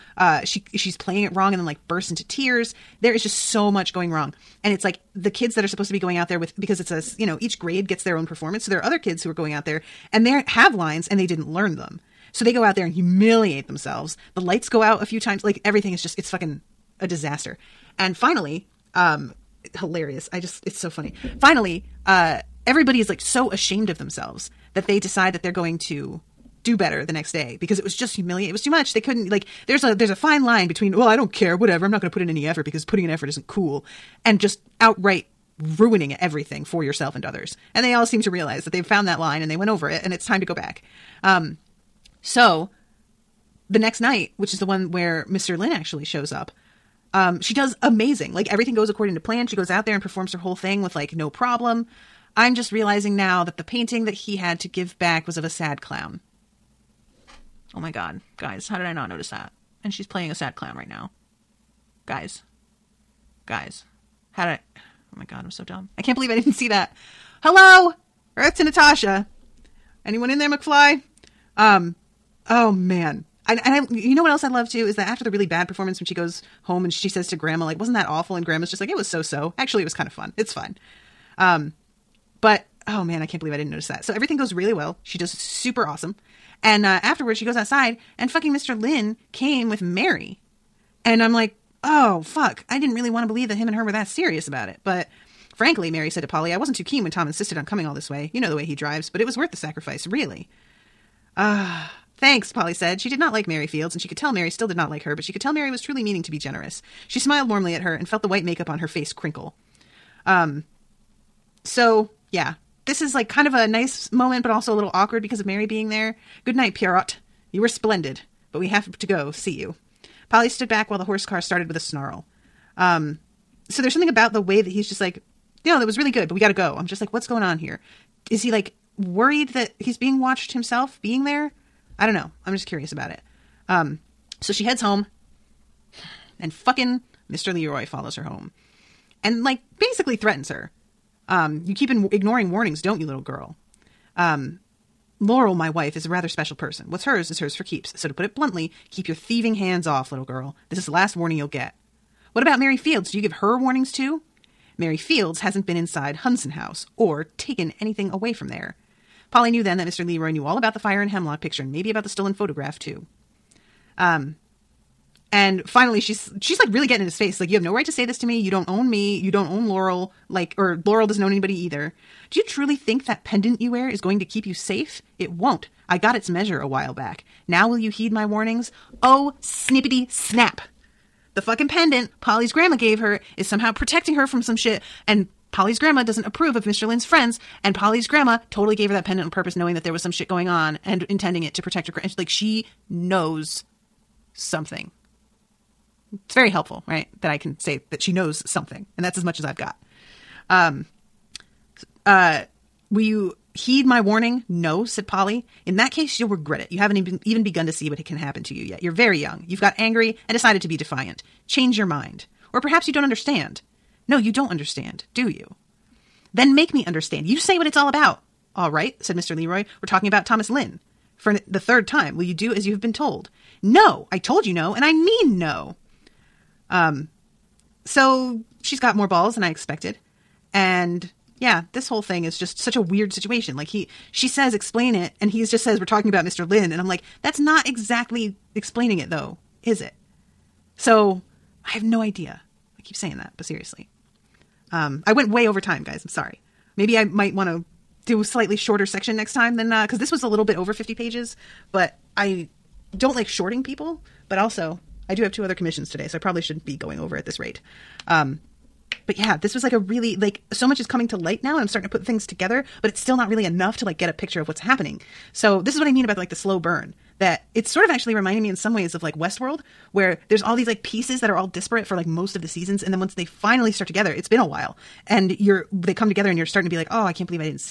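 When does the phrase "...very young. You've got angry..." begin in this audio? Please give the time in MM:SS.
03:28.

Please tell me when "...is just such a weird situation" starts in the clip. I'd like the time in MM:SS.
03:52.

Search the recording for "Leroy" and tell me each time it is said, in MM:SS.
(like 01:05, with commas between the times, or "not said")
02:17, 02:40, 03:39.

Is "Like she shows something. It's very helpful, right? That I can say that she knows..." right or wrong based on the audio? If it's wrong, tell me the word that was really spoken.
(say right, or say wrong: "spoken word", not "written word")
wrong: "knows", not "shows".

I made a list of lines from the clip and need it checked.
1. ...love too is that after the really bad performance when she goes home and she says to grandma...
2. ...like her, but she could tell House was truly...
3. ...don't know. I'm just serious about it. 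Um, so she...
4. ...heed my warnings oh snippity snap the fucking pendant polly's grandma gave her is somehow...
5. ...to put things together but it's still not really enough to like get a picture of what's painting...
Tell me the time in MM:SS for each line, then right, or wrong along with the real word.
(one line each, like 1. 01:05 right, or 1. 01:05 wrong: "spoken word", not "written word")
1. 01:14 right
2. 01:44 wrong: "Mary", not "House"
3. 02:12 wrong: "curious", not "serious"
4. 02:57 right
5. 04:21 wrong: "happening", not "painting".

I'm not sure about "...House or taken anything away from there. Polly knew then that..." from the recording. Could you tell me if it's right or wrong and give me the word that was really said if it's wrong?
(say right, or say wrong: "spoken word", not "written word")
right.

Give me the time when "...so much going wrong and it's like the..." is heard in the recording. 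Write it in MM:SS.
00:03.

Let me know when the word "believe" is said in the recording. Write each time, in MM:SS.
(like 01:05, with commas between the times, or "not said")
01:06, 01:23, 01:33.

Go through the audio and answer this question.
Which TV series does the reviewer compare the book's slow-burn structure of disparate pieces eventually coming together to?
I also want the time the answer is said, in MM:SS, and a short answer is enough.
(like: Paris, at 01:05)
Westworld, at 04:29.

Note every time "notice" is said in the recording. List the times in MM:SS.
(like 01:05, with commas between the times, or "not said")
00:59, 01:23.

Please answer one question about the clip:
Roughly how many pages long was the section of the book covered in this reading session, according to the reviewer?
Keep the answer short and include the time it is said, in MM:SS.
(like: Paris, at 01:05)
a little over 50, at 04:10.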